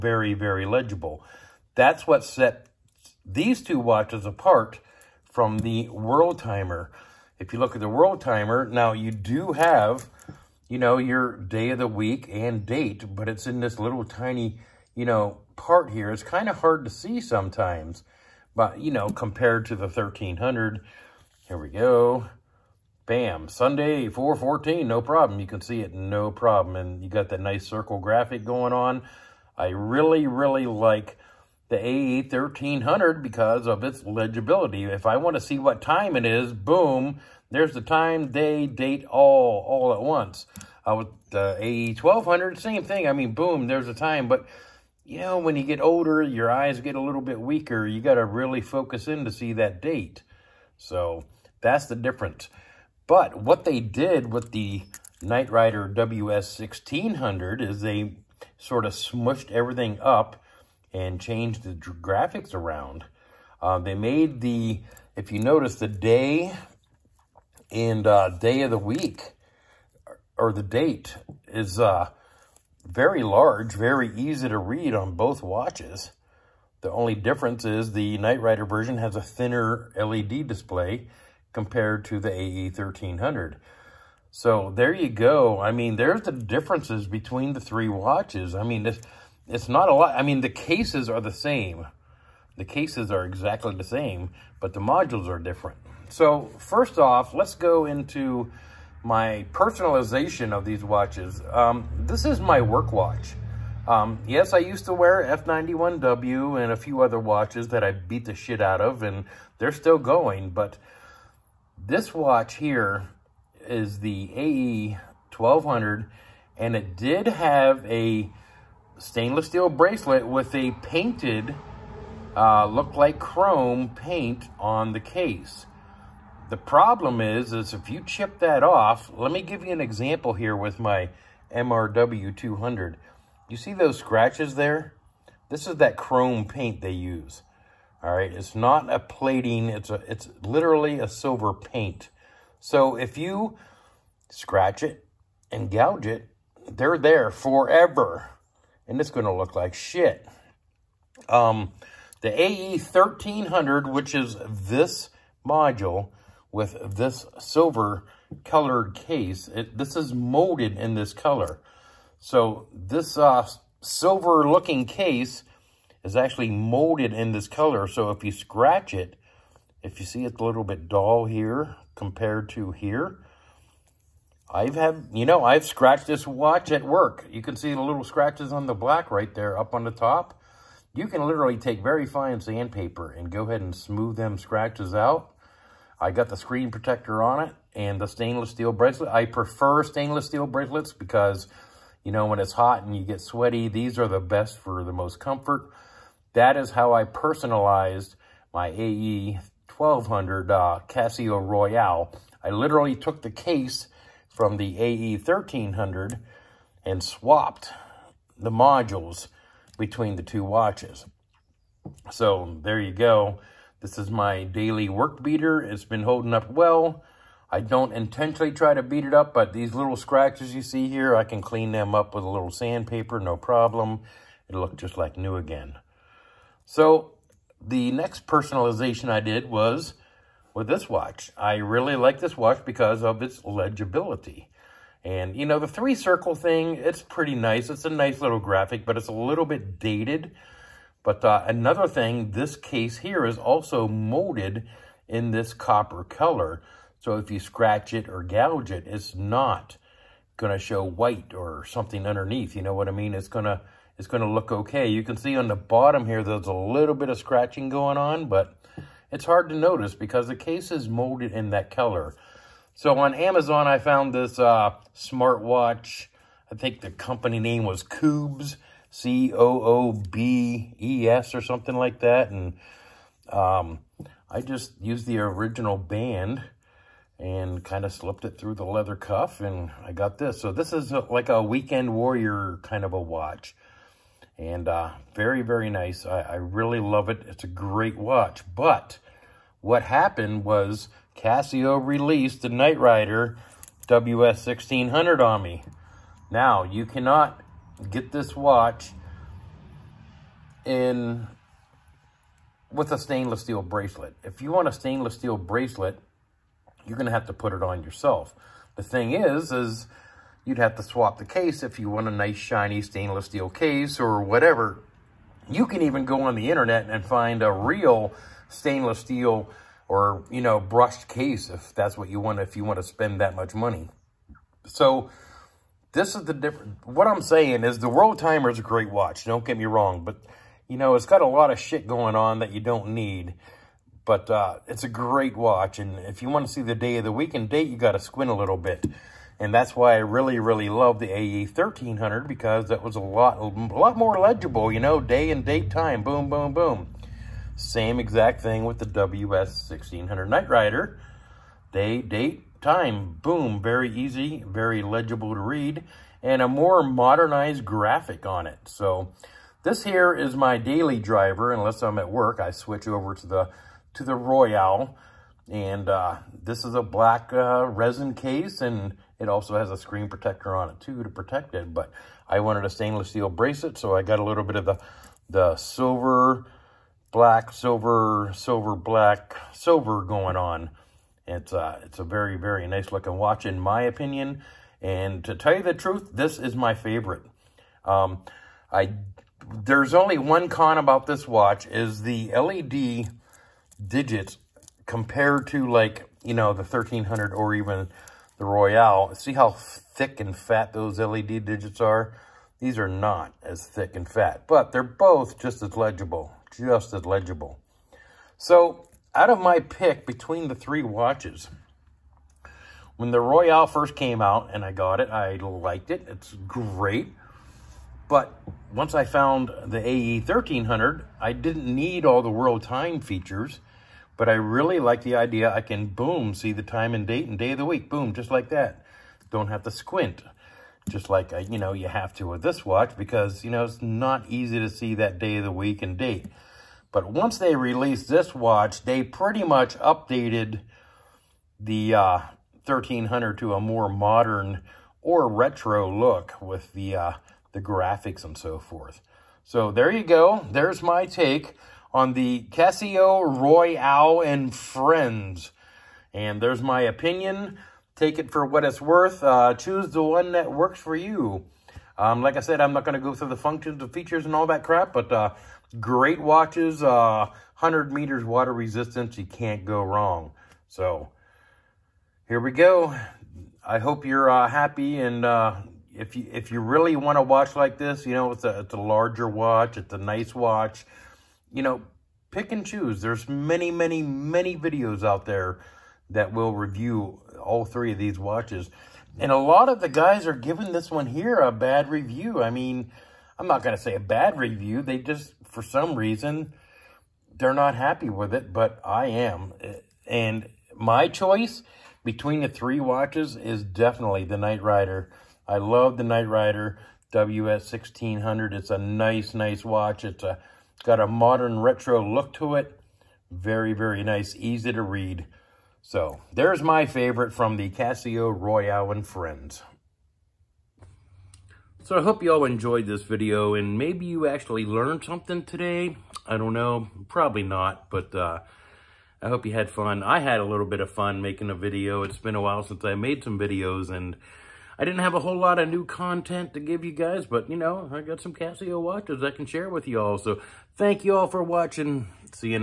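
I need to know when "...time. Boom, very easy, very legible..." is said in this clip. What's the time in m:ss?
5:52.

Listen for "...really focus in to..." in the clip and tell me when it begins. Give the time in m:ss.
0:48.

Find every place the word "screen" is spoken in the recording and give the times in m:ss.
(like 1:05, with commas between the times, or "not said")
3:06, 6:09.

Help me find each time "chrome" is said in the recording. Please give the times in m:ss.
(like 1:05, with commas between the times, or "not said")
2:03, 2:15.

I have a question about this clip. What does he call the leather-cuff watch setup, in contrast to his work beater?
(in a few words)
weekend warrior.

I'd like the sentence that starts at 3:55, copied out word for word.
And, you know, the three circle thing, it's pretty nice.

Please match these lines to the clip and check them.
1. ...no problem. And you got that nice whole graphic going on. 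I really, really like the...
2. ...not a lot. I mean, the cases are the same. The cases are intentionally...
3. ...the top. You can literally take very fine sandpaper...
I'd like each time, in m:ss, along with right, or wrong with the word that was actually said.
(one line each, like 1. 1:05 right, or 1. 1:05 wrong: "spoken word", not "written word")
1. 0:25 wrong: "circle", not "whole"
2. 1:29 wrong: "exactly", not "intentionally"
3. 2:59 right.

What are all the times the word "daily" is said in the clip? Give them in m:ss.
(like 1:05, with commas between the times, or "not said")
3:34, 6:00.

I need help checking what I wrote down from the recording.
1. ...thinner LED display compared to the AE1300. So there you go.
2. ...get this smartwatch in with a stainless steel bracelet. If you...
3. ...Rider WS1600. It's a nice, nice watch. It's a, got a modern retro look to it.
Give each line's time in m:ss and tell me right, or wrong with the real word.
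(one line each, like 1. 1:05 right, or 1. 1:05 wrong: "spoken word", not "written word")
1. 1:19 right
2. 4:57 wrong: "watch", not "smartwatch"
3. 8:26 right.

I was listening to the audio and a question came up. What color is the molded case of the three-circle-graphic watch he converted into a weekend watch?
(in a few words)
copper.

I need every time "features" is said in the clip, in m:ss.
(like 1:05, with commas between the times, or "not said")
7:02, 7:43.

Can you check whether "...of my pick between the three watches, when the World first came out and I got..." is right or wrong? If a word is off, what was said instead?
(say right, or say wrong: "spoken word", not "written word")
wrong: "Royale", not "World".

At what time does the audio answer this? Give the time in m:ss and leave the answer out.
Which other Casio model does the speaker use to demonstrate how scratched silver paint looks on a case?
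2:11.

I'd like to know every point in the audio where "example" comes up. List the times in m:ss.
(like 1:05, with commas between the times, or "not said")
2:09.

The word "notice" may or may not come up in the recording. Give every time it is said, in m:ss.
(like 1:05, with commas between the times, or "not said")
1:05, 4:19.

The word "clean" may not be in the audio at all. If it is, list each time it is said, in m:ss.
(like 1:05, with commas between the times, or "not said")
3:41.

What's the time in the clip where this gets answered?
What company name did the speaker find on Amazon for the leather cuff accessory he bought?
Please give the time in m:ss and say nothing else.
4:27.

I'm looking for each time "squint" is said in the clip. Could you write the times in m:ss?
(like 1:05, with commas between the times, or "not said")
5:37, 7:09.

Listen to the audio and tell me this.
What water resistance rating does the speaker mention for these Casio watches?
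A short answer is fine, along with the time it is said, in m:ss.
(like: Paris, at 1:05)
100 meters, at 7:47.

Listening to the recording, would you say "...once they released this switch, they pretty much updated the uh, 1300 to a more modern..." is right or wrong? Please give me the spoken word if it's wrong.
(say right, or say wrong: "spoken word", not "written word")
wrong: "watch", not "switch".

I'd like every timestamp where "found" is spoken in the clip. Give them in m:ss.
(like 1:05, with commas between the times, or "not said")
4:23, 6:59.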